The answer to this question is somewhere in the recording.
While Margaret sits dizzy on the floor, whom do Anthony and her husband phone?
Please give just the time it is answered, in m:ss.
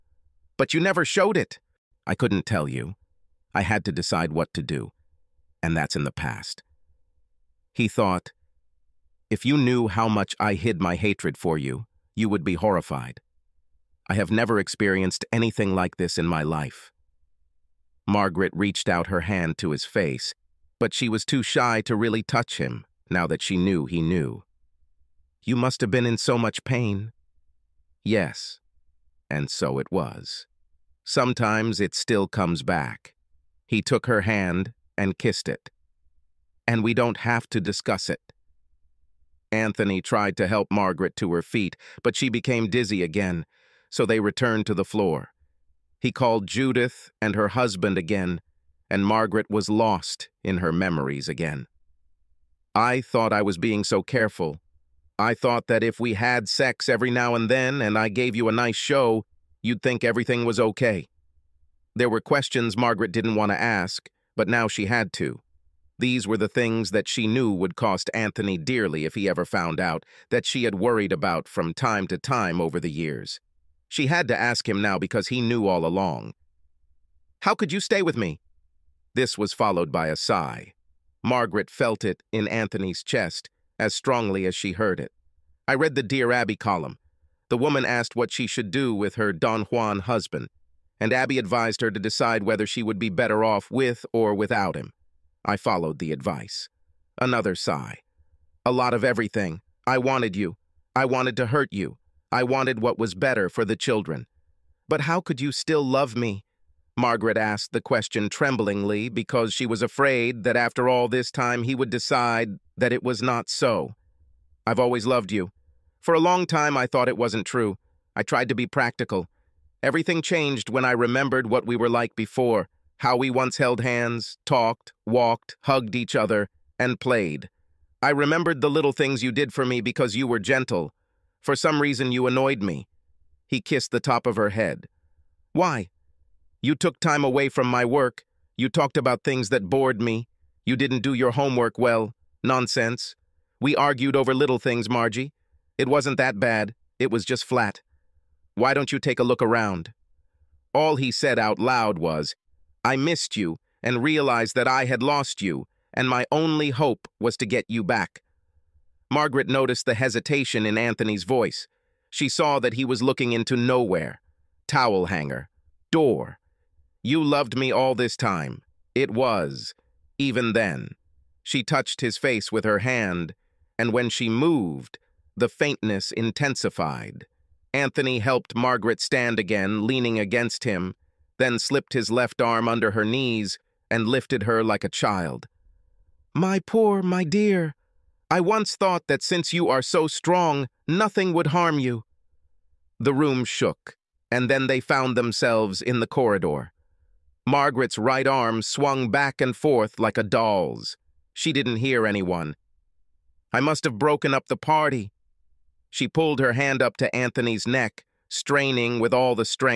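0:46.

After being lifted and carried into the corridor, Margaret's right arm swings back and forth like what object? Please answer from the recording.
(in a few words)
a doll.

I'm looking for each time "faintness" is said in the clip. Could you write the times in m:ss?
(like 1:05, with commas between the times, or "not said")
2:55.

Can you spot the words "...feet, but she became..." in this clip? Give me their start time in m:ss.
0:41.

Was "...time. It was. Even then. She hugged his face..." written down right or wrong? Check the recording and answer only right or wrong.
wrong.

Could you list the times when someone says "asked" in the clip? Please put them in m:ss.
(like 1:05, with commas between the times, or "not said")
1:27, 1:47.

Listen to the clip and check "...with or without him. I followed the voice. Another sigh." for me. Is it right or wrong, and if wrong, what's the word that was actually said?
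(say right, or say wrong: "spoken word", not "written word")
wrong: "advice", not "voice".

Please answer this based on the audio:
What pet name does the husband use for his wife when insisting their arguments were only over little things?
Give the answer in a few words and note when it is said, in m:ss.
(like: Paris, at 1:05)
Margie, at 2:24.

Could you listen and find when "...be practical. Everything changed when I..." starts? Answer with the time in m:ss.
1:58.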